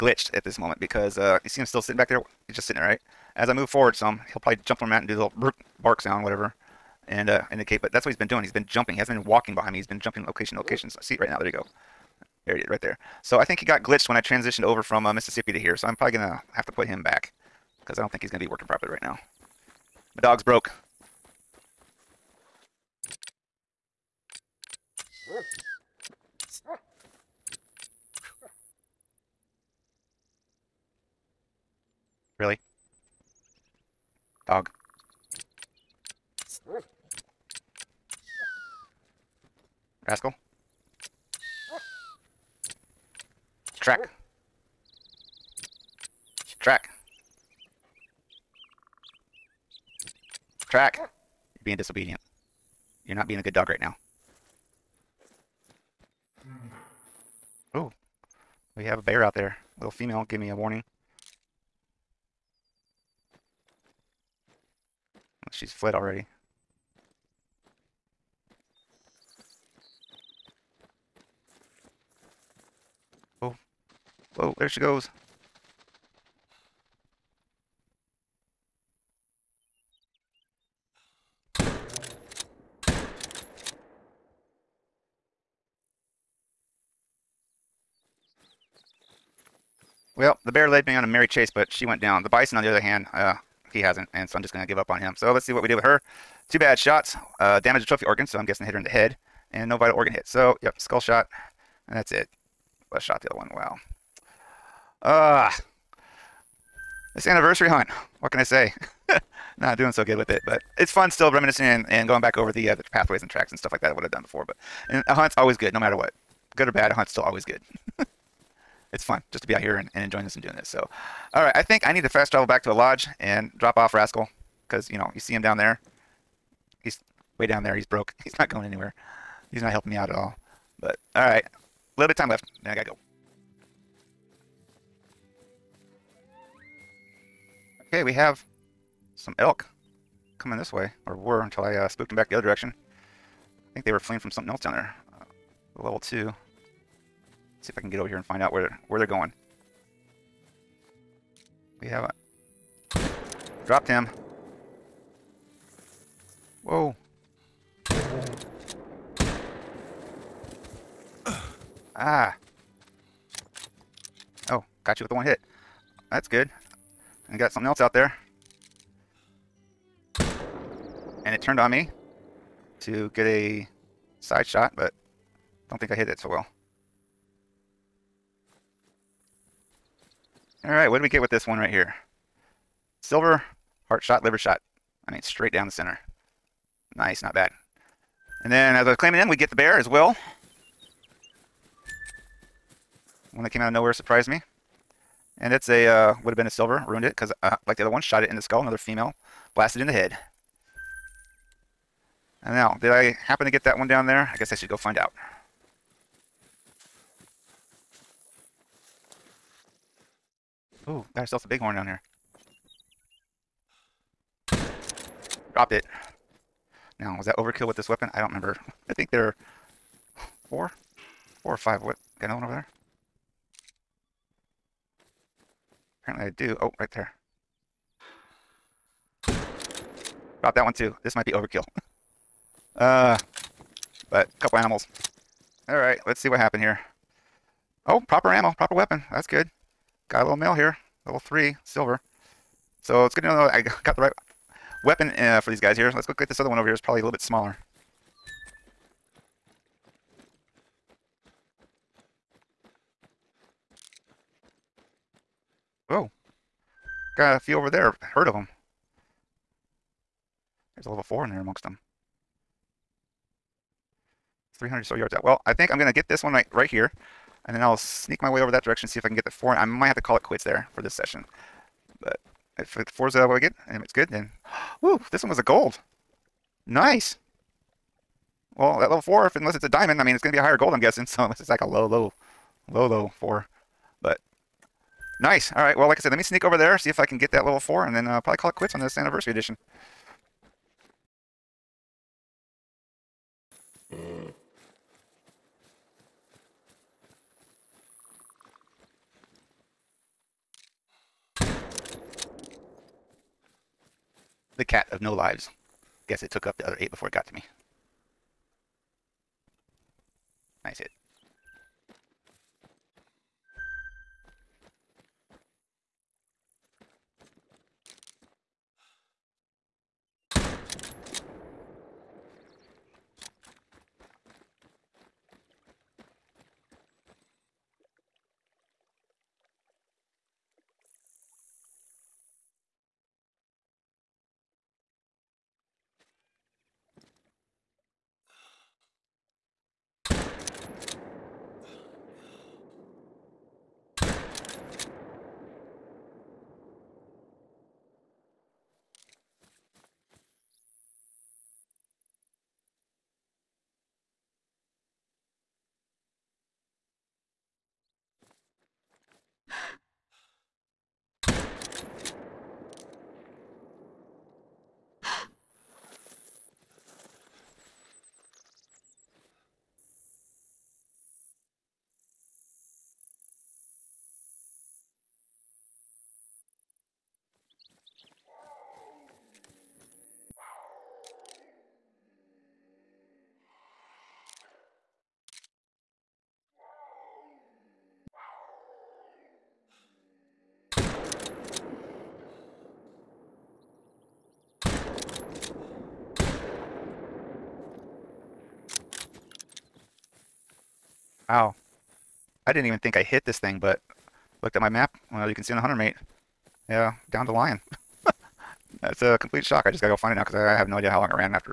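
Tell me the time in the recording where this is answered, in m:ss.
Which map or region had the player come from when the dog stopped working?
0:15.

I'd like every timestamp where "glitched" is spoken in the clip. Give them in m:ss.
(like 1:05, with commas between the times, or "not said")
0:13.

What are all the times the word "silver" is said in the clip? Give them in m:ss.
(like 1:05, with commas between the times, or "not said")
3:03, 3:16, 4:01.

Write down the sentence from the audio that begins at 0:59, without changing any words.
Little female give me a warning.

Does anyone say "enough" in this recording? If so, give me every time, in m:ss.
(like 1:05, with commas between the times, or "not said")
not said.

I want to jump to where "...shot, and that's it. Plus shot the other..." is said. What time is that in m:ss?
1:40.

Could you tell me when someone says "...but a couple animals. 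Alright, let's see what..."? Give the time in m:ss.
3:54.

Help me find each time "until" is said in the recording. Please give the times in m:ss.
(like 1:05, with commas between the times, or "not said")
2:21.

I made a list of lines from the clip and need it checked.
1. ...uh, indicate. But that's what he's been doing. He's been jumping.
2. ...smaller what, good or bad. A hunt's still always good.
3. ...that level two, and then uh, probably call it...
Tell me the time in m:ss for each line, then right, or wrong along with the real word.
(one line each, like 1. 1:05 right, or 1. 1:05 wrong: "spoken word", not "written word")
1. 0:07 right
2. 1:55 wrong: "matter", not "smaller"
3. 4:47 wrong: "four", not "two".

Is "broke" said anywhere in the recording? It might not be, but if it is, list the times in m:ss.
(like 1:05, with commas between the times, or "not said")
0:20, 2:07.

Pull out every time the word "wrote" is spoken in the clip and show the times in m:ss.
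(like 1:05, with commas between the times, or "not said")
not said.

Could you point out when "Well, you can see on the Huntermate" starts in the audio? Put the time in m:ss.
6:45.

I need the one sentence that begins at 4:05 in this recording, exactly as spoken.
Let's go get this other one over here.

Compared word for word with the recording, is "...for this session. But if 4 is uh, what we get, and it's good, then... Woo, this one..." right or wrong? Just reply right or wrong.
right.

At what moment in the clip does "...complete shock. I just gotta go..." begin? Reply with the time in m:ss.
6:49.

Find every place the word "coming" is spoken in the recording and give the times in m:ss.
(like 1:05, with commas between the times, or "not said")
2:20.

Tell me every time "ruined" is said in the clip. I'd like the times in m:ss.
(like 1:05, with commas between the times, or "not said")
3:16.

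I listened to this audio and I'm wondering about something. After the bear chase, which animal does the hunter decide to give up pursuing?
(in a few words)
bison.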